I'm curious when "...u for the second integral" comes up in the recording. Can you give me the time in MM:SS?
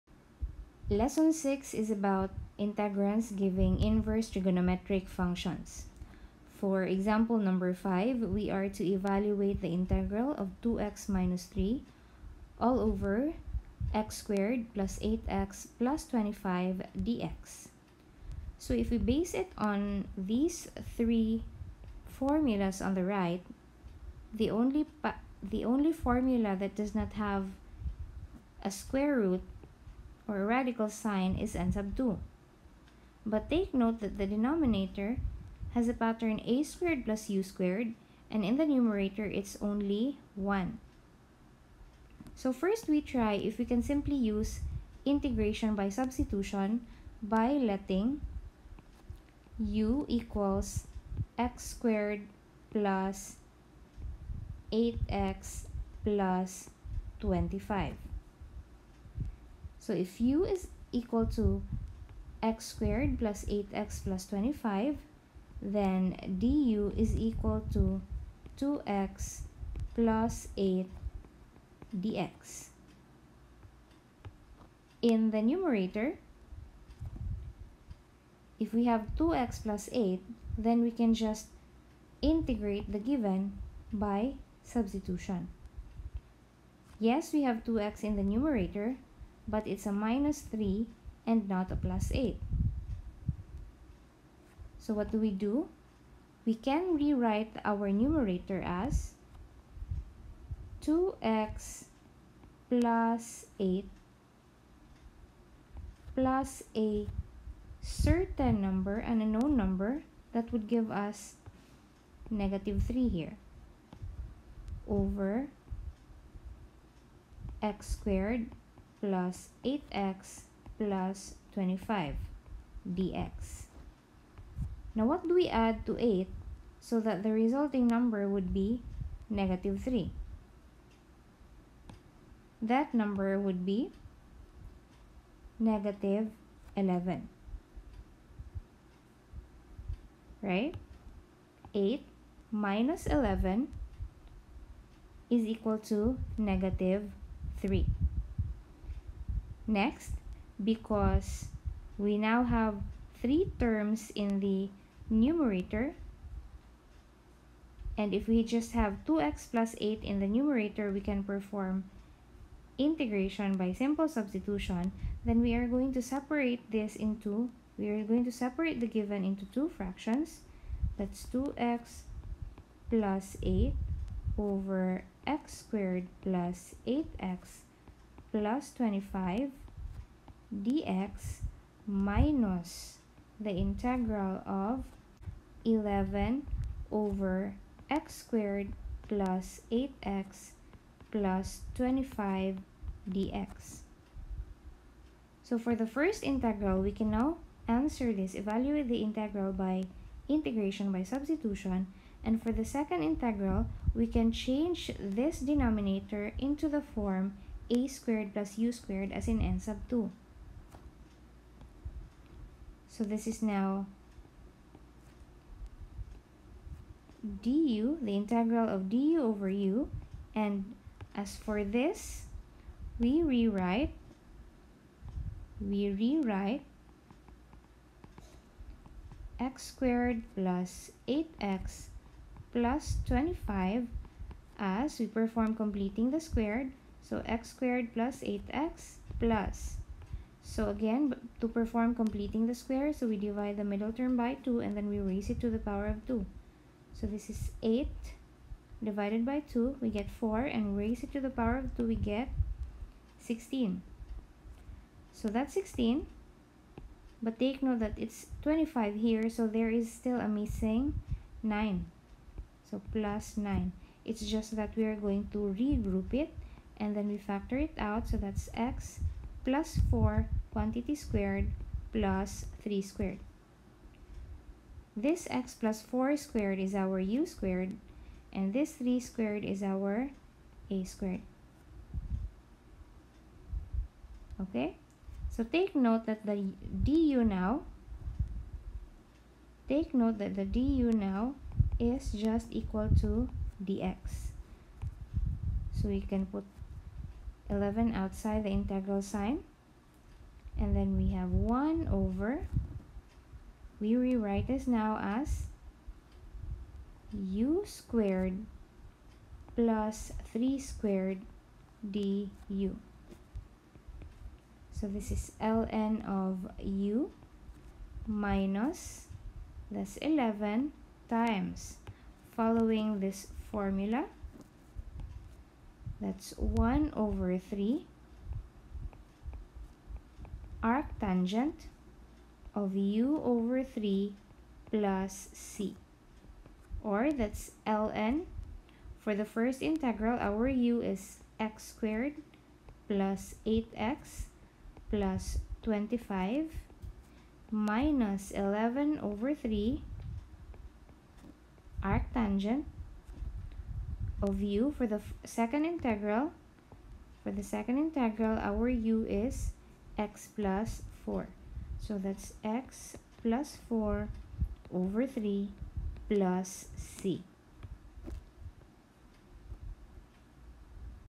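05:54.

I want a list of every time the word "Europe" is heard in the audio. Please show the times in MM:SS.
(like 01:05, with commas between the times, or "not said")
not said.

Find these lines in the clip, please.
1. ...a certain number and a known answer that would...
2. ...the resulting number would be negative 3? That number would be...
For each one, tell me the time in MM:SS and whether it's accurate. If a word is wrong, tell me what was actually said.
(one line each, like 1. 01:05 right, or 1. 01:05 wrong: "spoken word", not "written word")
1. 01:46 wrong: "number", not "answer"
2. 02:07 right.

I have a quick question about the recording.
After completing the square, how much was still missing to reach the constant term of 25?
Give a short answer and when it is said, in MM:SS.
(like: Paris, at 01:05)
9, at 04:20.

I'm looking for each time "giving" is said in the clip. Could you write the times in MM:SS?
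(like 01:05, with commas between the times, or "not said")
00:03.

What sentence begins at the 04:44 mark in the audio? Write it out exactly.
Okay, so take note that the du now, take note that the du now is just equal to dx.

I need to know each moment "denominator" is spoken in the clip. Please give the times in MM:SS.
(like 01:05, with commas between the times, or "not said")
00:34, 03:25.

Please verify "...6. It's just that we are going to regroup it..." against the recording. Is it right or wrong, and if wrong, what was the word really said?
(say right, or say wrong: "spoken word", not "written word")
wrong: "9", not "6".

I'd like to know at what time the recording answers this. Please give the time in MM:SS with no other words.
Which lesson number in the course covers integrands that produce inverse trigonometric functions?
00:00.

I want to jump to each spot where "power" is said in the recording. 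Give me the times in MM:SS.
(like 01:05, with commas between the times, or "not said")
04:05, 04:11.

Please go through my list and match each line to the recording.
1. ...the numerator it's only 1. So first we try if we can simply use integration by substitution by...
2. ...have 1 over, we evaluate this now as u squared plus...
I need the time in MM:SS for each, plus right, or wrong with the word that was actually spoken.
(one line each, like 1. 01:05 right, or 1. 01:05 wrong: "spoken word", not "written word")
1. 00:38 right
2. 05:01 wrong: "rewrite", not "evaluate".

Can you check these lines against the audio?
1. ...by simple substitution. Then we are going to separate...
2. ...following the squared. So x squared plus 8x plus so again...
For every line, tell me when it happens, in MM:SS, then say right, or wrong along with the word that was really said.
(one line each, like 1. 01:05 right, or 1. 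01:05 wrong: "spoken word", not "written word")
1. 02:43 right
2. 03:55 wrong: "completing", not "following".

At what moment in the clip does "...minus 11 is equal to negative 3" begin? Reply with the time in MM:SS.
02:22.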